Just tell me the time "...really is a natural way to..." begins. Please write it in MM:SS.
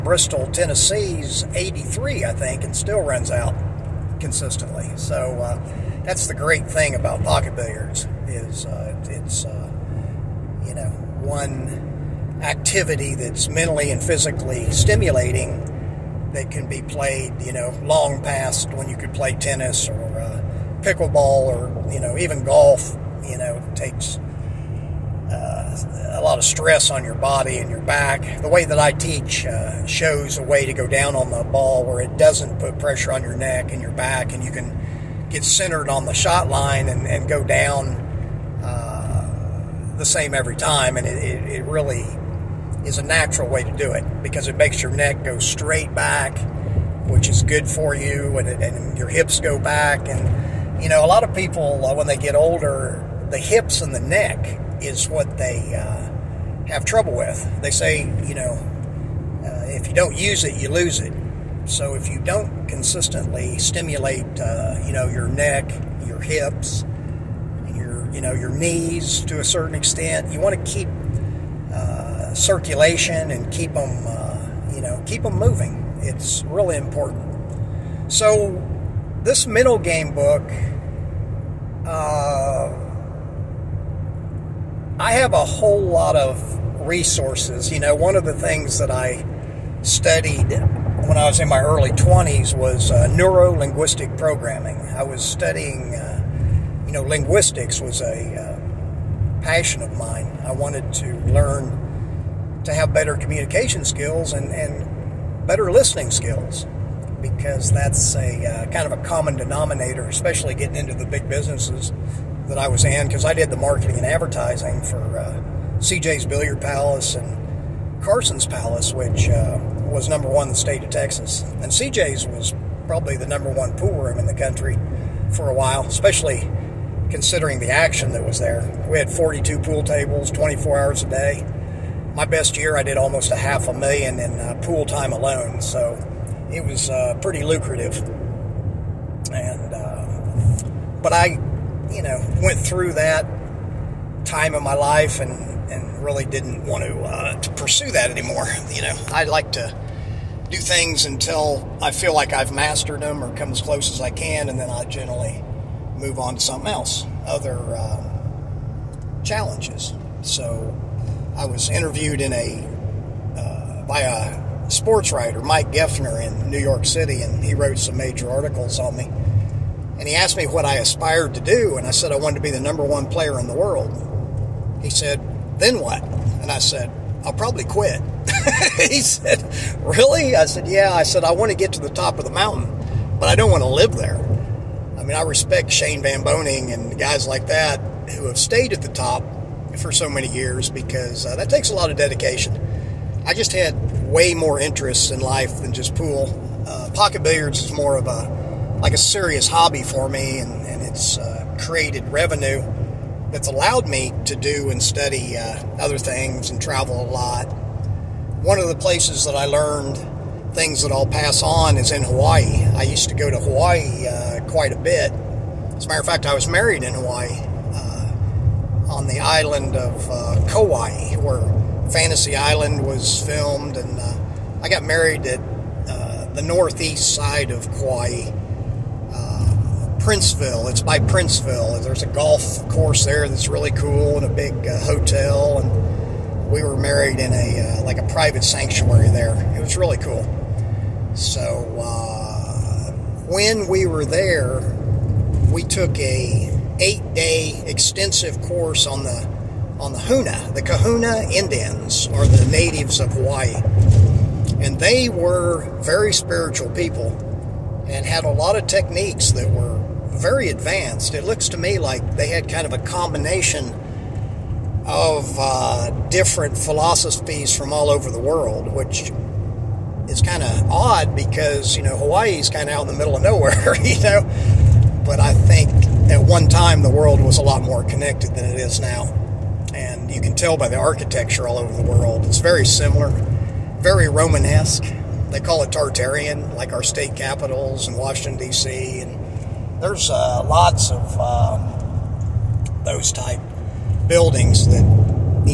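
00:41.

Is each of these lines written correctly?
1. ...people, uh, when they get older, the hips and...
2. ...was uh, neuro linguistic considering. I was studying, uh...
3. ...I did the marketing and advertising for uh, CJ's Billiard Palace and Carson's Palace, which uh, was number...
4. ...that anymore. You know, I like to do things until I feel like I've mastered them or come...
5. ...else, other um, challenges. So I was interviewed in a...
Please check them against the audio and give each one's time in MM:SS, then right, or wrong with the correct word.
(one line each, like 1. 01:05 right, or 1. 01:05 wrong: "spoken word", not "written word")
1. 00:51 right
2. 01:32 wrong: "programming", not "considering"
3. 01:53 right
4. 02:27 right
5. 02:36 right.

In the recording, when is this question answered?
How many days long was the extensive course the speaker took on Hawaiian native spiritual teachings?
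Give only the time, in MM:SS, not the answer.
04:06.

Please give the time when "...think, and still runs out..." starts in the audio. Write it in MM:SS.
00:02.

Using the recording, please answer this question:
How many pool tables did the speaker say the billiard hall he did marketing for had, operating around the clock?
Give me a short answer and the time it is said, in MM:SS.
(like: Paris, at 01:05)
42, at 02:09.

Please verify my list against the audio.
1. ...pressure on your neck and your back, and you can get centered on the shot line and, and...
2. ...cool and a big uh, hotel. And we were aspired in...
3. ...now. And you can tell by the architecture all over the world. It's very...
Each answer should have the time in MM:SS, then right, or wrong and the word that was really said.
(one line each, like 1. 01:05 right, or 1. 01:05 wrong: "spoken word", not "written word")
1. 00:32 right
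2. 03:53 wrong: "married", not "aspired"
3. 04:38 right.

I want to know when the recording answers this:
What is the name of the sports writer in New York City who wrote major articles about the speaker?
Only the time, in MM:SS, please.
02:45.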